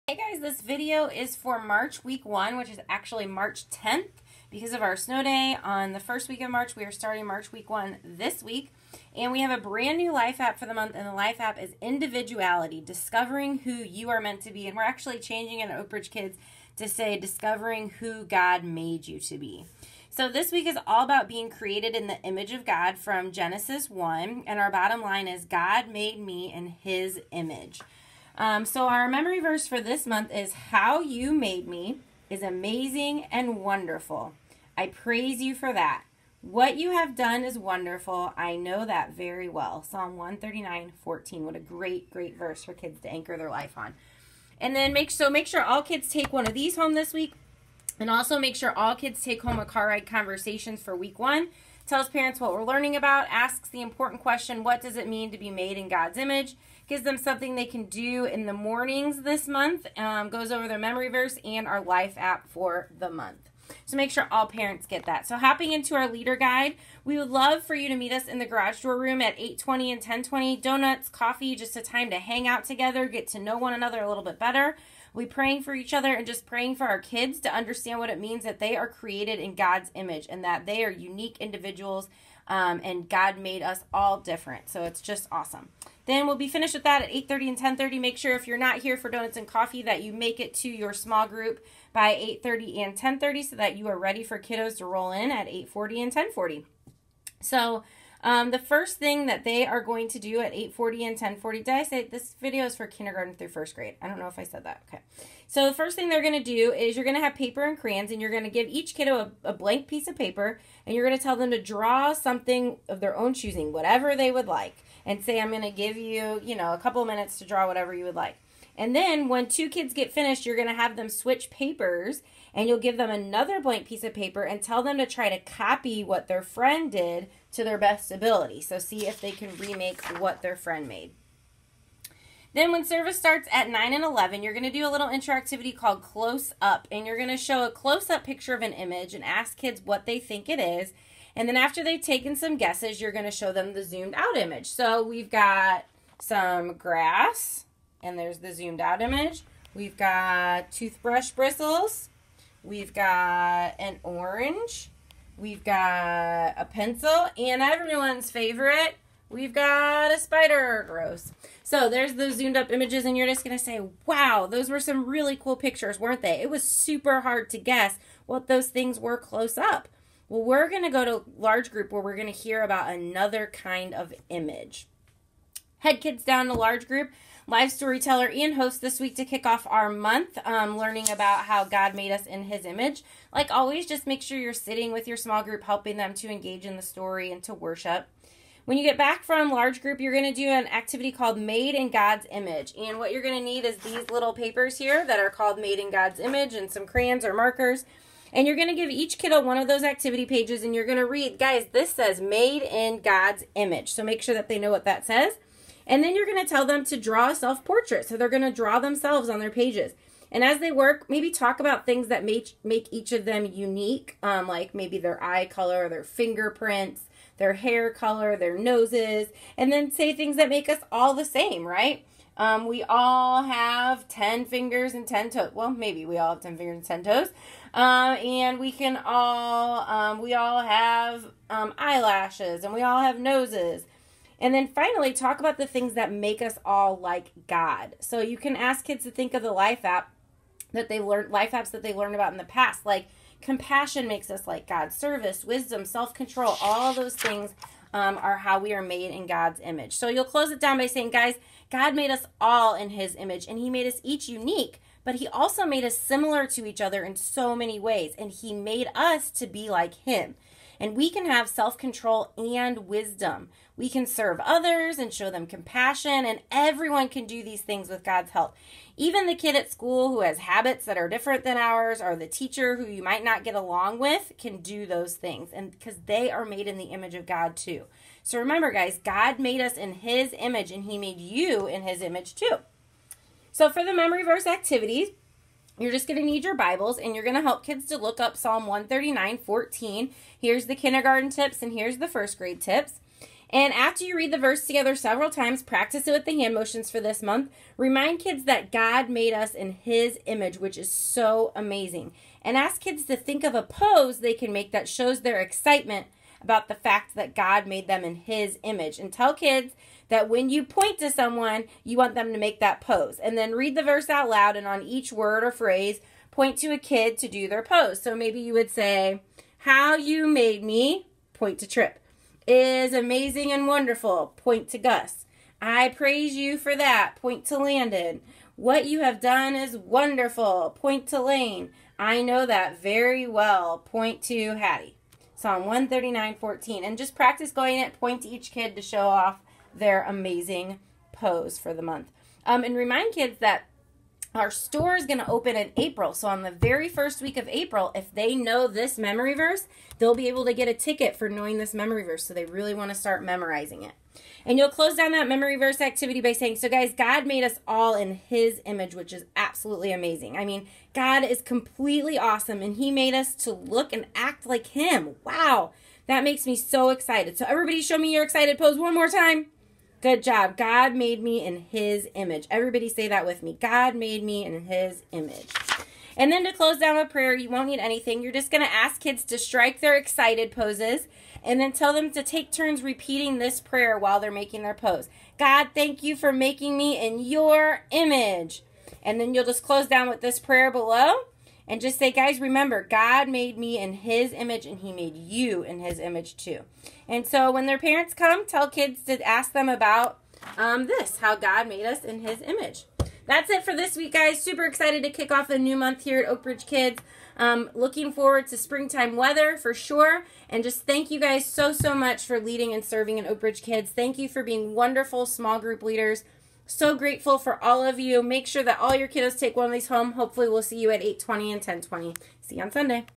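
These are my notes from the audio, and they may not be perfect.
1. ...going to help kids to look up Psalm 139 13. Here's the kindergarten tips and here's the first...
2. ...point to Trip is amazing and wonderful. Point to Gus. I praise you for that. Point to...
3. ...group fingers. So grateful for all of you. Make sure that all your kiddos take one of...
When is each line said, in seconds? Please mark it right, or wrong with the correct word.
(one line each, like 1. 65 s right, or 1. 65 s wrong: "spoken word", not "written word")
1. 287 s wrong: "14", not "13"
2. 321 s right
3. 415 s wrong: "leaders", not "fingers".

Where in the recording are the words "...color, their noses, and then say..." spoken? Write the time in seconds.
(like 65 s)
217 s.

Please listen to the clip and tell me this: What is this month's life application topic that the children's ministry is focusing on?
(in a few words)
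Individuality.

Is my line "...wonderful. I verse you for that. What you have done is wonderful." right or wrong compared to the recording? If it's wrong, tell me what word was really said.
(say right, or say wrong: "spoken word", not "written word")
wrong: "praise", not "verse".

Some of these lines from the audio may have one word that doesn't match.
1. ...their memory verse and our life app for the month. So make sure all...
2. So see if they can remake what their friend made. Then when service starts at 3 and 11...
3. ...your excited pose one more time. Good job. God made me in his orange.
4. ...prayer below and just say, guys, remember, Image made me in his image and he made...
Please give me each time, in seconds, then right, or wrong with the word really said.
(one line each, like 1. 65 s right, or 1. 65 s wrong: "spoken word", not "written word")
1. 60 s right
2. 128 s wrong: "9", not "3"
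3. 368 s wrong: "image", not "orange"
4. 390 s wrong: "God", not "Image".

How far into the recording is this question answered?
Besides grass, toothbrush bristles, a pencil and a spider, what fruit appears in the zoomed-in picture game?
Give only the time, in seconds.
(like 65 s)
153 s.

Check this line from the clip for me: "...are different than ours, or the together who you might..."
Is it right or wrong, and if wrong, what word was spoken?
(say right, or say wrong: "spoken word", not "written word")
wrong: "teacher", not "together".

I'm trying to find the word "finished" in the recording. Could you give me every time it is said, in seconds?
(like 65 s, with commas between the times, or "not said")
86 s, 120 s.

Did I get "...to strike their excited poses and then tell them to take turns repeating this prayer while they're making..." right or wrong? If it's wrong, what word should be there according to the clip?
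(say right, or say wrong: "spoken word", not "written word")
right.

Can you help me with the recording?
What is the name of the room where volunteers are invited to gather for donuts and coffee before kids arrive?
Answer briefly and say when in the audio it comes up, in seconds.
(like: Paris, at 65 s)
garage door room, at 68 s.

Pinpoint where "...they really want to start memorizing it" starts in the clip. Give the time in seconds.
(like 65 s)
352 s.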